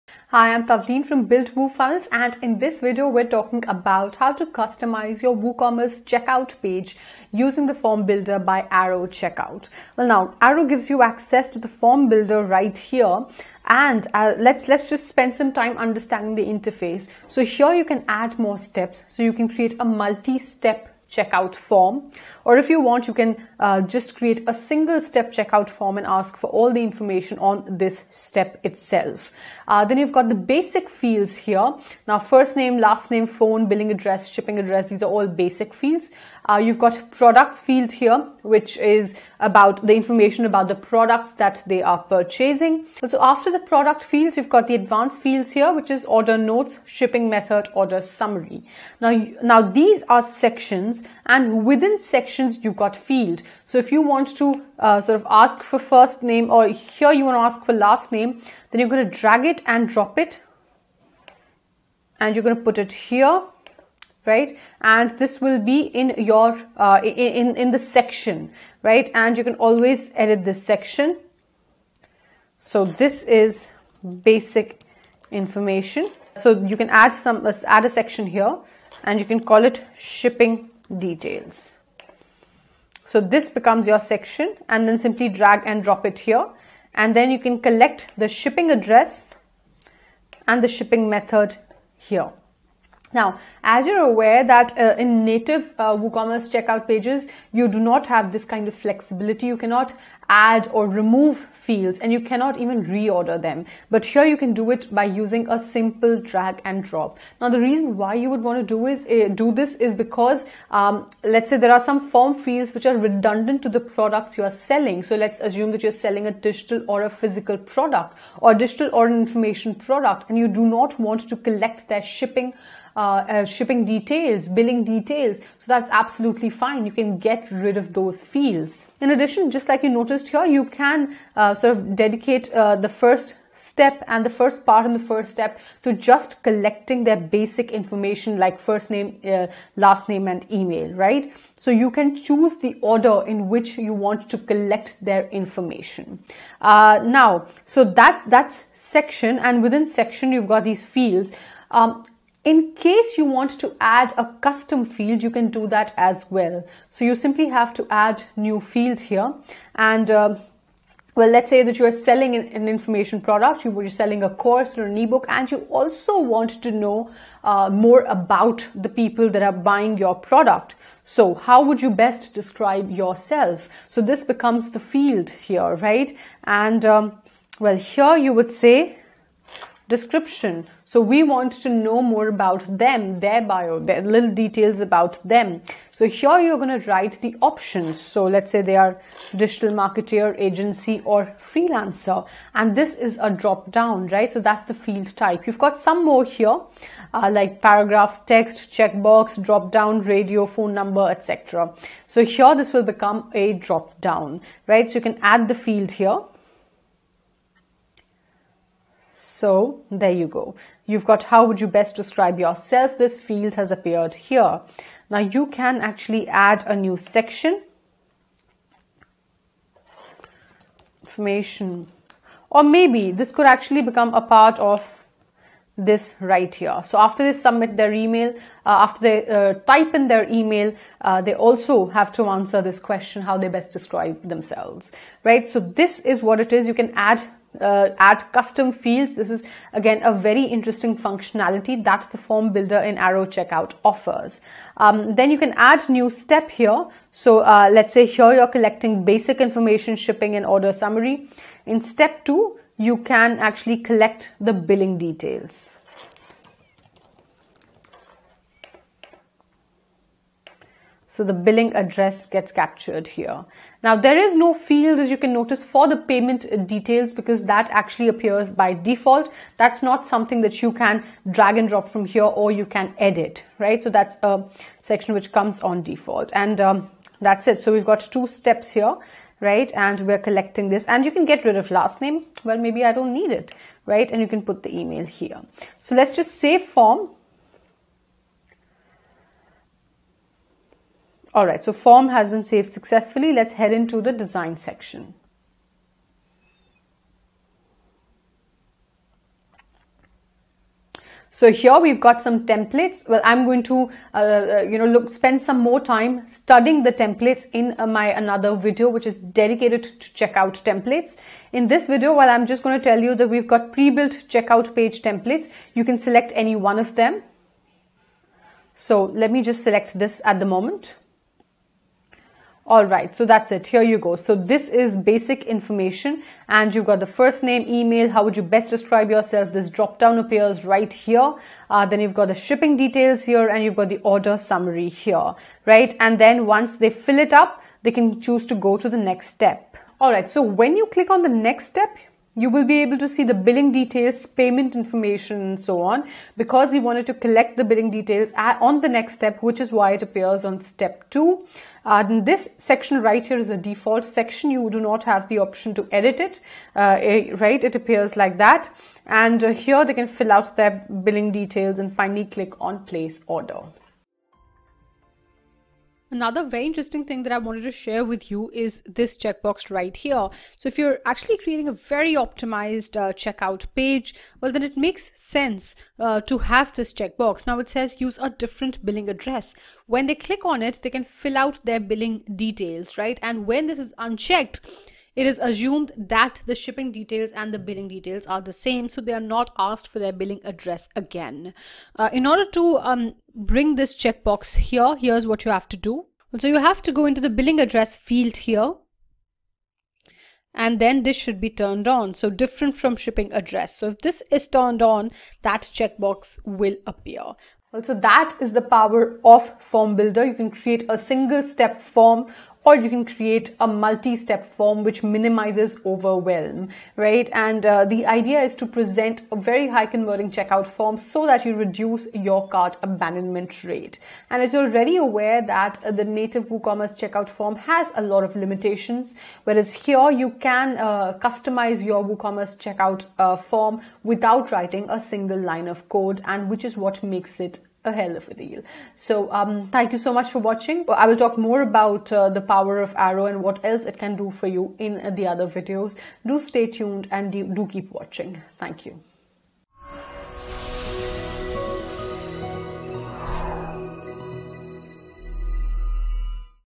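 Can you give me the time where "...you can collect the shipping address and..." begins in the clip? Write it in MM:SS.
01:27.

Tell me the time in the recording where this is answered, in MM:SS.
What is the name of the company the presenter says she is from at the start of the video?
00:01.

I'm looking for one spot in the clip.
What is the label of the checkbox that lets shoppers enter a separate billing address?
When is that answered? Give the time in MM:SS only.
06:18.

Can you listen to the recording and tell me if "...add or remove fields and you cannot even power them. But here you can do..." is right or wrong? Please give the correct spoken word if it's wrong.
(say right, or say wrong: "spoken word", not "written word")
wrong: "reorder", not "power".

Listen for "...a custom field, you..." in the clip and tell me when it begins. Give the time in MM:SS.
02:34.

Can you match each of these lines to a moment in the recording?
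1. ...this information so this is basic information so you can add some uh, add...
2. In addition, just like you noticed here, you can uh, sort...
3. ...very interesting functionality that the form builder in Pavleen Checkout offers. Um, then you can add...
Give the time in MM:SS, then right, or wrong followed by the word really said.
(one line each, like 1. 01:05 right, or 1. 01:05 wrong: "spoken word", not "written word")
1. 01:10 wrong: "section", not "information"
2. 02:08 right
3. 04:00 wrong: "Aero", not "Pavleen".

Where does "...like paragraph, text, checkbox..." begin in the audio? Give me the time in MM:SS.
03:17.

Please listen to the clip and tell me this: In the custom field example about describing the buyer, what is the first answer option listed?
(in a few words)
Digital marketer.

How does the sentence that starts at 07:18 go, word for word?
So um, thank you so much for watching.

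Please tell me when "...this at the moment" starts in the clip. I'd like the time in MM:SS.
05:19.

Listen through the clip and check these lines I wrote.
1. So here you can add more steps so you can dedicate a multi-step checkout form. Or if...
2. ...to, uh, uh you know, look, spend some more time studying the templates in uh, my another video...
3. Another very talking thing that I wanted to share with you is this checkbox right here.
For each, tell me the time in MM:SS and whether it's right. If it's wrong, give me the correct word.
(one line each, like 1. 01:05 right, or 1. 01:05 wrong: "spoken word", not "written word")
1. 00:17 wrong: "create", not "dedicate"
2. 05:03 right
3. 06:06 wrong: "interesting", not "talking".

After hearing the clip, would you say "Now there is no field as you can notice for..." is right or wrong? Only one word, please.
right.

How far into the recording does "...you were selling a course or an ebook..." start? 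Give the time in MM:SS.
02:43.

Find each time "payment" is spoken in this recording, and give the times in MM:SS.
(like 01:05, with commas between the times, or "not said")
04:25, 05:44.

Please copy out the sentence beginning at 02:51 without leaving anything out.
So how would you best describe yourself?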